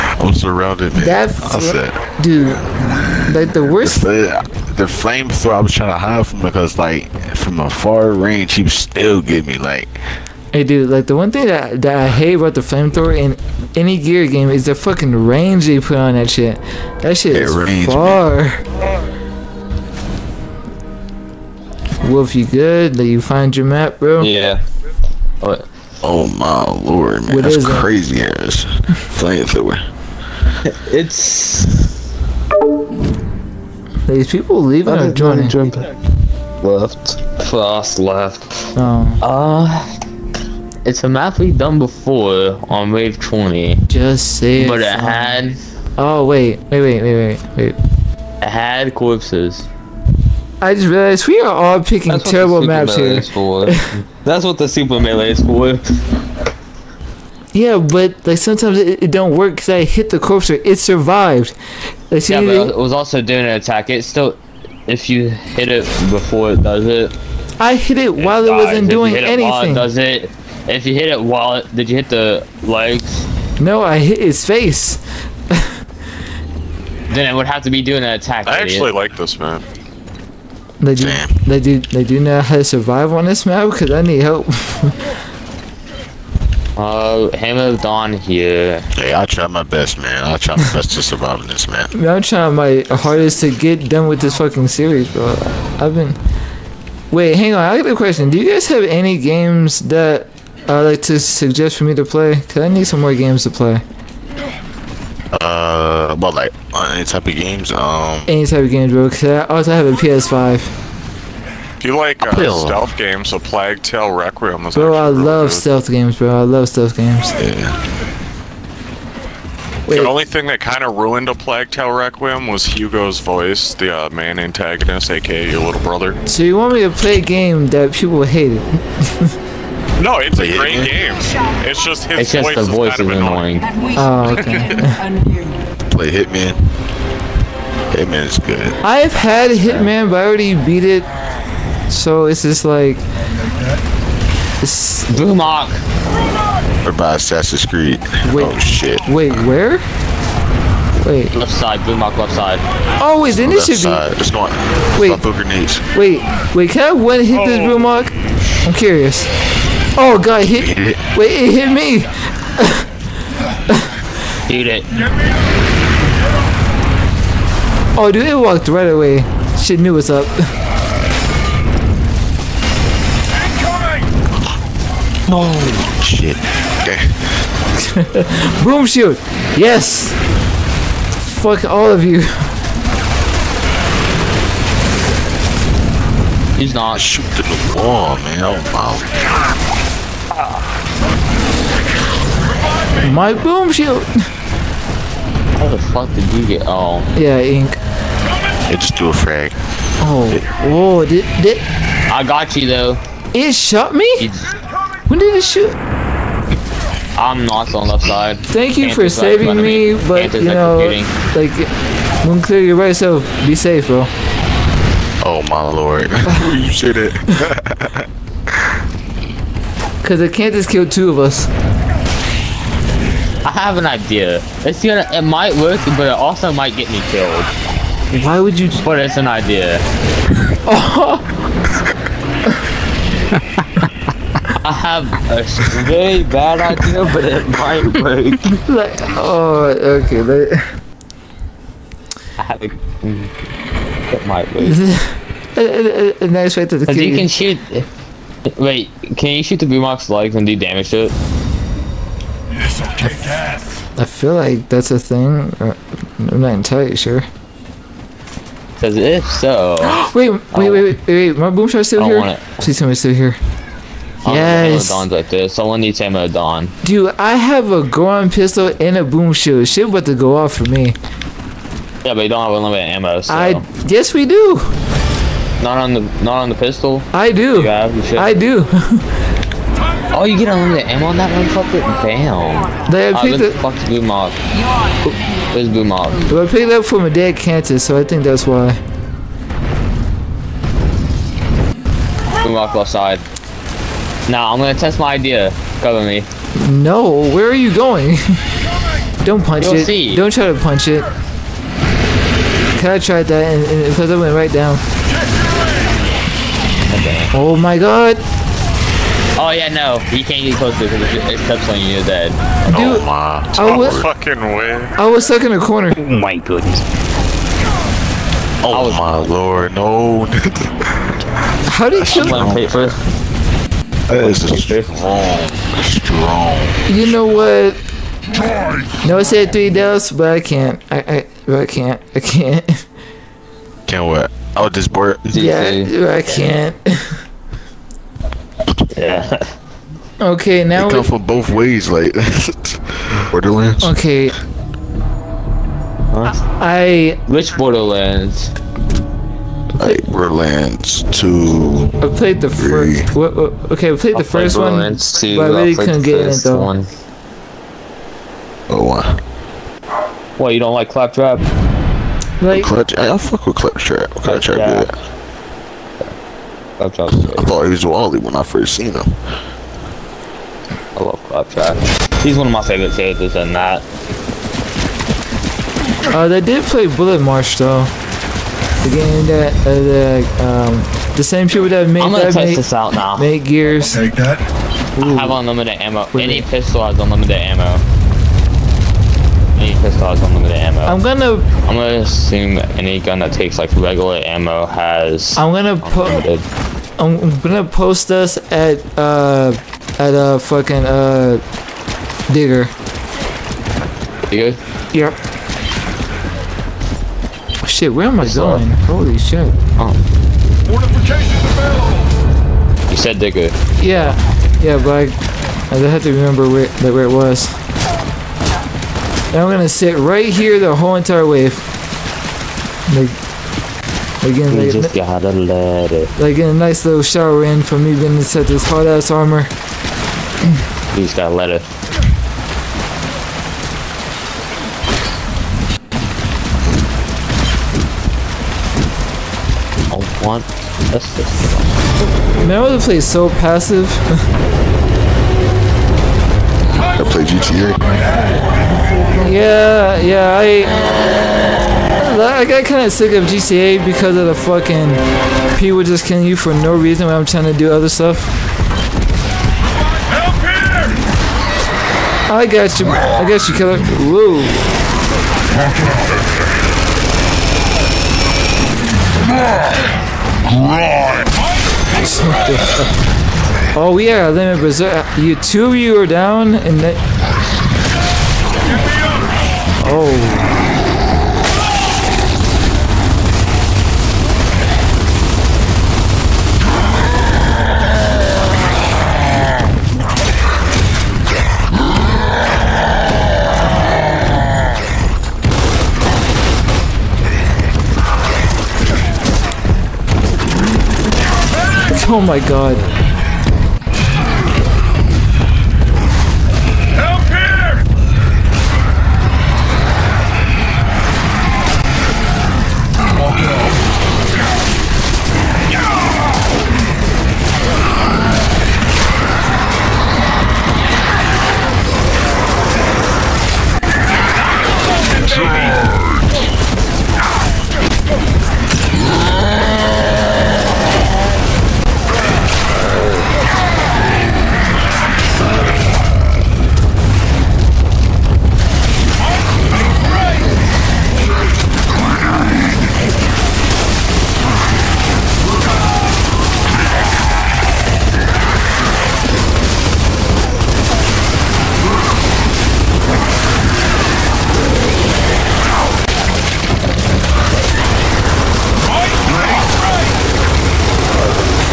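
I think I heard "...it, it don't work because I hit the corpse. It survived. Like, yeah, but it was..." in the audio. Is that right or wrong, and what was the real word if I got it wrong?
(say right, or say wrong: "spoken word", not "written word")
right.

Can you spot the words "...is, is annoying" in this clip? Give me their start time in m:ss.
2:12.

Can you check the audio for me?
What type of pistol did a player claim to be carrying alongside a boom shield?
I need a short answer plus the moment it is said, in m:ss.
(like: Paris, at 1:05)
Gorgon, at 4:27.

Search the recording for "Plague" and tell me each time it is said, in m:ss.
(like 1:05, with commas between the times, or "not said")
1:53, 2:01.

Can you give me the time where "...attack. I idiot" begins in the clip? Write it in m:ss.
1:18.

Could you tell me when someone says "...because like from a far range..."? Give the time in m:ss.
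0:06.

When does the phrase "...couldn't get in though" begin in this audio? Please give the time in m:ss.
5:55.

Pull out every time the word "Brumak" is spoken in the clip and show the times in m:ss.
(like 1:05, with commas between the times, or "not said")
2:25, 2:31, 2:37.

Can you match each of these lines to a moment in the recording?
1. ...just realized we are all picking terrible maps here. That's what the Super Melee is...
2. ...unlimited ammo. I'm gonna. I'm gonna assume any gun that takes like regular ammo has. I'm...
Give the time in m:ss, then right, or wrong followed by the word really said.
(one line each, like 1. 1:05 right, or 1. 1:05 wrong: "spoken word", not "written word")
1. 0:50 right
2. 6:30 right.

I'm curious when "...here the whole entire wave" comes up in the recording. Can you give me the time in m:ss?
7:00.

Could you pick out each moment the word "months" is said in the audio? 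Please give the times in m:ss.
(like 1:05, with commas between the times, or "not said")
not said.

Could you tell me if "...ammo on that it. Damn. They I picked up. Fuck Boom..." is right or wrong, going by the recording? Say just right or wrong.
right.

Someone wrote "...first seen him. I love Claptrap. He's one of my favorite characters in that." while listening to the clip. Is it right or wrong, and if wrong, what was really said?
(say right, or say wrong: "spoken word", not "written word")
right.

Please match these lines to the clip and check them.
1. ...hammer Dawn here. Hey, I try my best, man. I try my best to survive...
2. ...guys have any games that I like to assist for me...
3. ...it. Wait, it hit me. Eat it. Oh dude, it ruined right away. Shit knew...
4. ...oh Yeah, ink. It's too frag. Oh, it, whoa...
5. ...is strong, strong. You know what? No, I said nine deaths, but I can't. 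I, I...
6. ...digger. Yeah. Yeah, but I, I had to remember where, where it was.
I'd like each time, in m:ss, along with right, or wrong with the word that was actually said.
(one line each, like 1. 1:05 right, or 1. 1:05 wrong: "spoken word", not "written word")
1. 1:27 right
2. 1:38 wrong: "suggest", not "assist"
3. 2:40 wrong: "walked", not "ruined"
4. 3:16 right
5. 5:24 wrong: "three", not "nine"
6. 6:53 right.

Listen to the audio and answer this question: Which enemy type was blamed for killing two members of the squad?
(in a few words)
Kantus.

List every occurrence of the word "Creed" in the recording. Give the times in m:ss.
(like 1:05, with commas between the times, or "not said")
2:27.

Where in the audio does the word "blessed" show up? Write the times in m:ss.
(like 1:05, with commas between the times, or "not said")
not said.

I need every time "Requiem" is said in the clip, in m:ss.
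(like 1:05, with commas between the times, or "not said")
1:54, 2:01.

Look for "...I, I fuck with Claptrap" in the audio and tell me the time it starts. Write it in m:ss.
6:02.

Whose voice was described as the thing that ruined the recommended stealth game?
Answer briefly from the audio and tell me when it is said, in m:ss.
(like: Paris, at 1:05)
Hugo, at 2:02.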